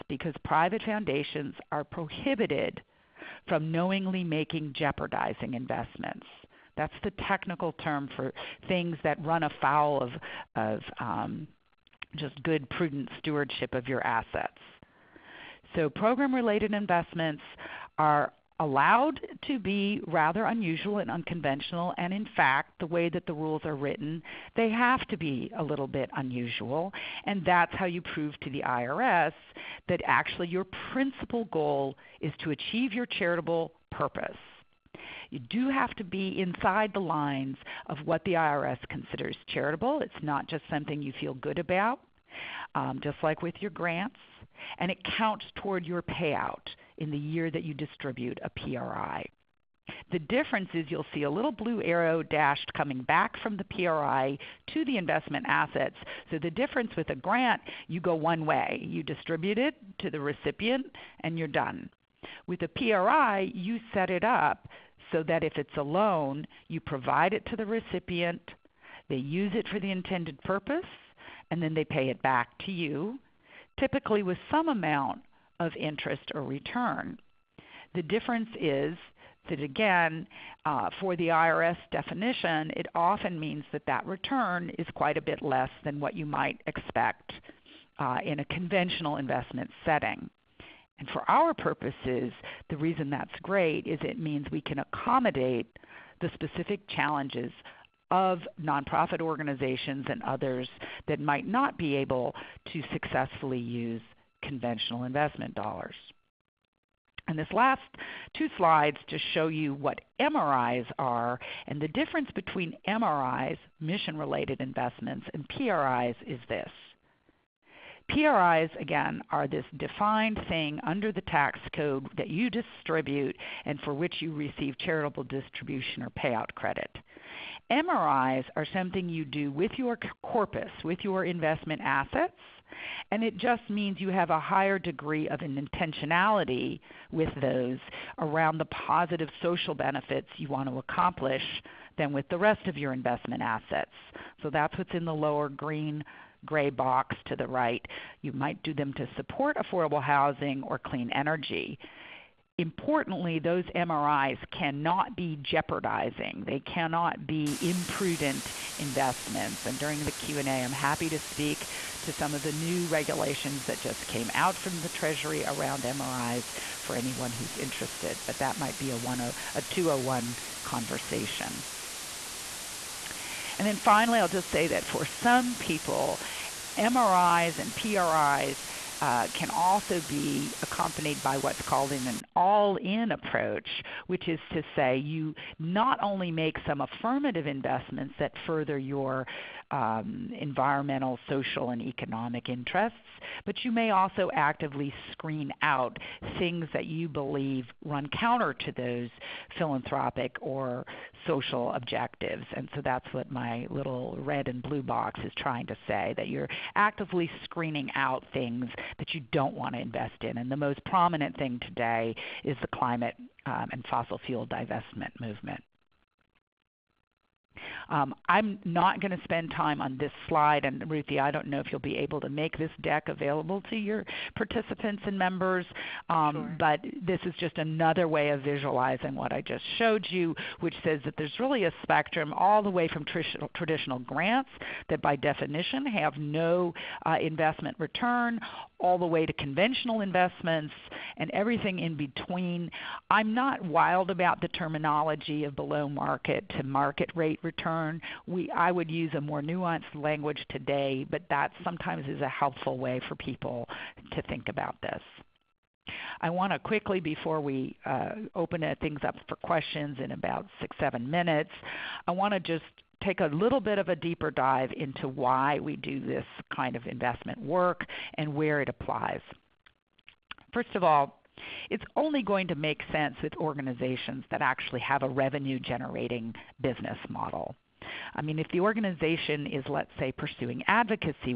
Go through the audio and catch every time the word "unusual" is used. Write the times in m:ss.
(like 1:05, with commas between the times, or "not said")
0:20, 0:26.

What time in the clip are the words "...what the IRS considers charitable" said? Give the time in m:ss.
0:38.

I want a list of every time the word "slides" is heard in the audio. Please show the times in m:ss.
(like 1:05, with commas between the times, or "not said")
1:48, 3:40.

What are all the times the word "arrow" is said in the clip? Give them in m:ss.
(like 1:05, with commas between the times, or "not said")
0:51.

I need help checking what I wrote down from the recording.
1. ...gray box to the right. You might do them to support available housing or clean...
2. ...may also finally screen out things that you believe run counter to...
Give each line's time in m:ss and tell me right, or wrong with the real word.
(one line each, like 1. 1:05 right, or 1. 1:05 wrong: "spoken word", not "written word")
1. 2:26 wrong: "affordable", not "available"
2. 3:13 wrong: "actively", not "finally".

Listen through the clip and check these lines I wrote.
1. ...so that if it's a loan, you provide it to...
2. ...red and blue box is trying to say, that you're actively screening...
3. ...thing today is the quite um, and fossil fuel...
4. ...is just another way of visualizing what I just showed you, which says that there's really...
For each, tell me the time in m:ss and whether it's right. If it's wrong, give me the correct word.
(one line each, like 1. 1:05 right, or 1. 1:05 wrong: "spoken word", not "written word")
1. 1:05 right
2. 3:24 right
3. 3:31 wrong: "climate", not "quite"
4. 3:47 right.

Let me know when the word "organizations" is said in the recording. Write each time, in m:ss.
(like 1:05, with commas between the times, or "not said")
1:39, 4:33, 4:38.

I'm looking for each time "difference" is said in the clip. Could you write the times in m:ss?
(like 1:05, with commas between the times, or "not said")
0:50, 0:56, 1:18, 1:51.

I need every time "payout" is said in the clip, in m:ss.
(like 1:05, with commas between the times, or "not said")
0:46, 2:06.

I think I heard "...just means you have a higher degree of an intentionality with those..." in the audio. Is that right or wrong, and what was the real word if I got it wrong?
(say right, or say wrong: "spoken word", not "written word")
right.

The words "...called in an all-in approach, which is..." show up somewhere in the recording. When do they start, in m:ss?
3:01.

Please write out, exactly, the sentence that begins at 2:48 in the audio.
But that might be a, 10, a 201 conversation.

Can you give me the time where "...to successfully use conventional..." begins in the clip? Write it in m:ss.
1:42.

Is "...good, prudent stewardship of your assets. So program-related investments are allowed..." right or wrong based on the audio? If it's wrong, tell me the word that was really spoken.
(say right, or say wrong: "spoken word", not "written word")
right.